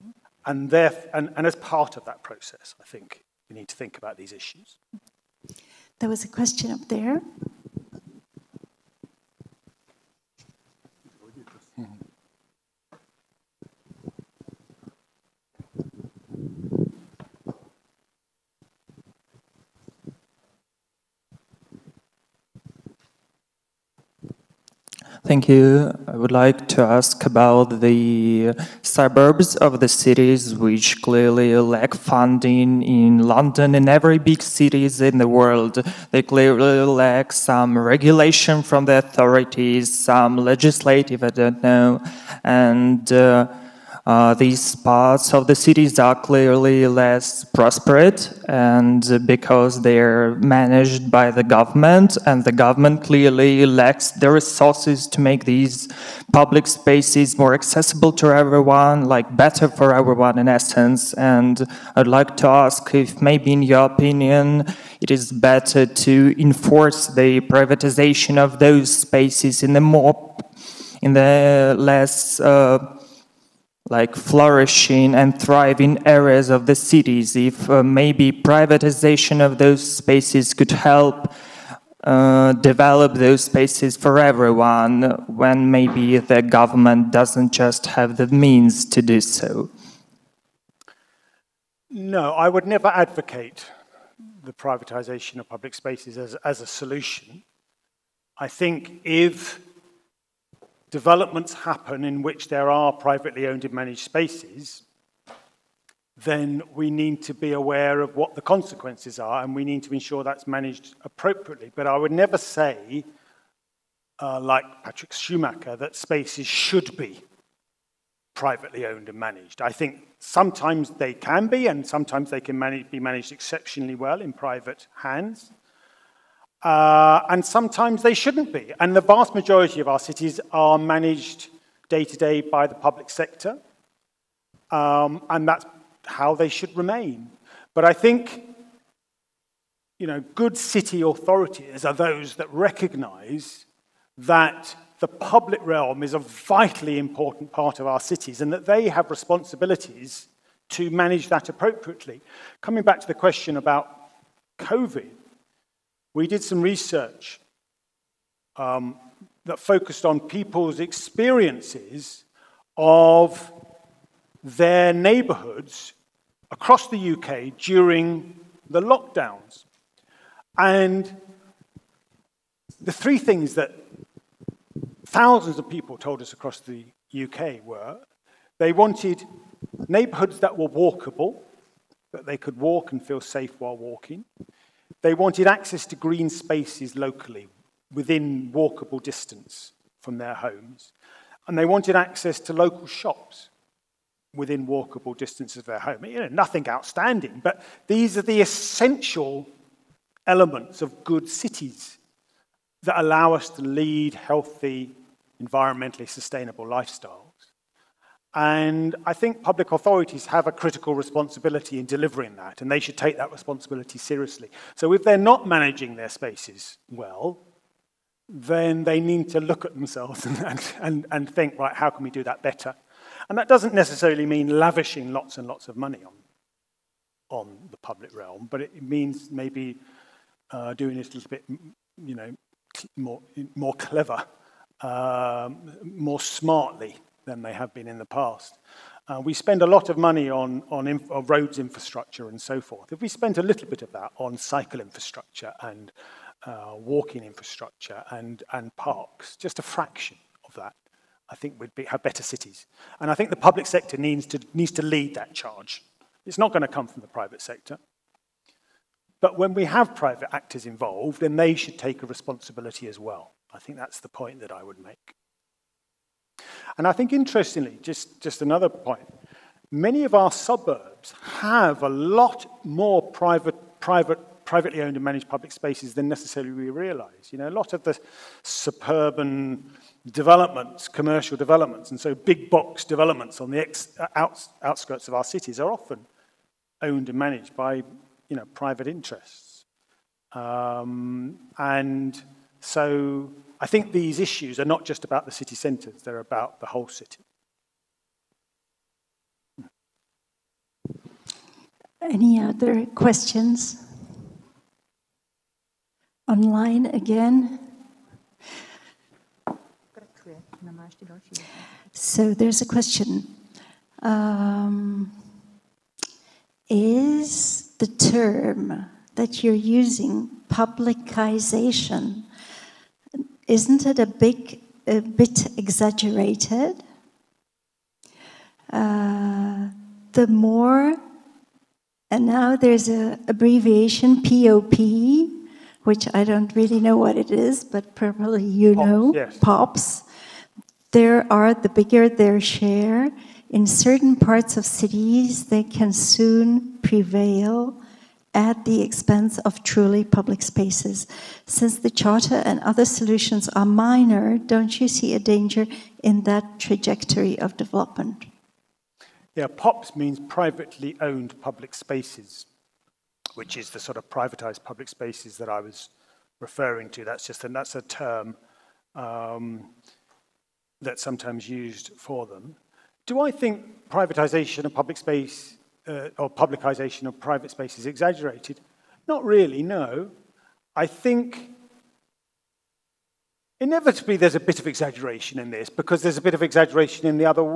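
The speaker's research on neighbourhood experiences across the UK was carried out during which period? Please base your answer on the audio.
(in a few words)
the lockdowns.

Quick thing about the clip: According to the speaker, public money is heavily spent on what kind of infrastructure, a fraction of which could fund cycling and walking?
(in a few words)
roads infrastructure.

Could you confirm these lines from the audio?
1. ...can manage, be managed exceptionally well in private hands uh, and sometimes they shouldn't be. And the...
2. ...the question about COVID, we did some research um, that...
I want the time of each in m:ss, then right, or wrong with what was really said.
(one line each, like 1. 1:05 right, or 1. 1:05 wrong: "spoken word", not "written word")
1. 2:02 right
2. 2:33 right.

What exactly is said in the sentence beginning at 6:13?
Do I think privatization of public space uh, or publicization of private space is exaggerated.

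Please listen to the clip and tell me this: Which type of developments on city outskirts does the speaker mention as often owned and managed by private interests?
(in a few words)
big box developments.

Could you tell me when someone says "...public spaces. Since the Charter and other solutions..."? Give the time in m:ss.
5:50.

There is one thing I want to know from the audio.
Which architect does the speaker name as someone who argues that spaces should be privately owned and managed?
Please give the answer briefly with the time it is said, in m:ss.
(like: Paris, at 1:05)
Patrick Schumacher, at 1:54.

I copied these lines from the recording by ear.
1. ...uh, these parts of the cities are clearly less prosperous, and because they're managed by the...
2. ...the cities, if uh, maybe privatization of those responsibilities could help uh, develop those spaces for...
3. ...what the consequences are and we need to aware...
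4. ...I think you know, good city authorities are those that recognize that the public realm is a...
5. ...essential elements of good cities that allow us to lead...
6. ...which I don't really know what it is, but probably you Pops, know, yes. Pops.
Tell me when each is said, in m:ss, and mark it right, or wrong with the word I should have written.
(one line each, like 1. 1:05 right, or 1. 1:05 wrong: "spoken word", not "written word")
1. 0:44 right
2. 1:16 wrong: "spaces", not "responsibilities"
3. 1:48 wrong: "ensure", not "aware"
4. 2:17 right
5. 3:18 right
6. 5:35 right.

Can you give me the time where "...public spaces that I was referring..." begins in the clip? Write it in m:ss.
6:04.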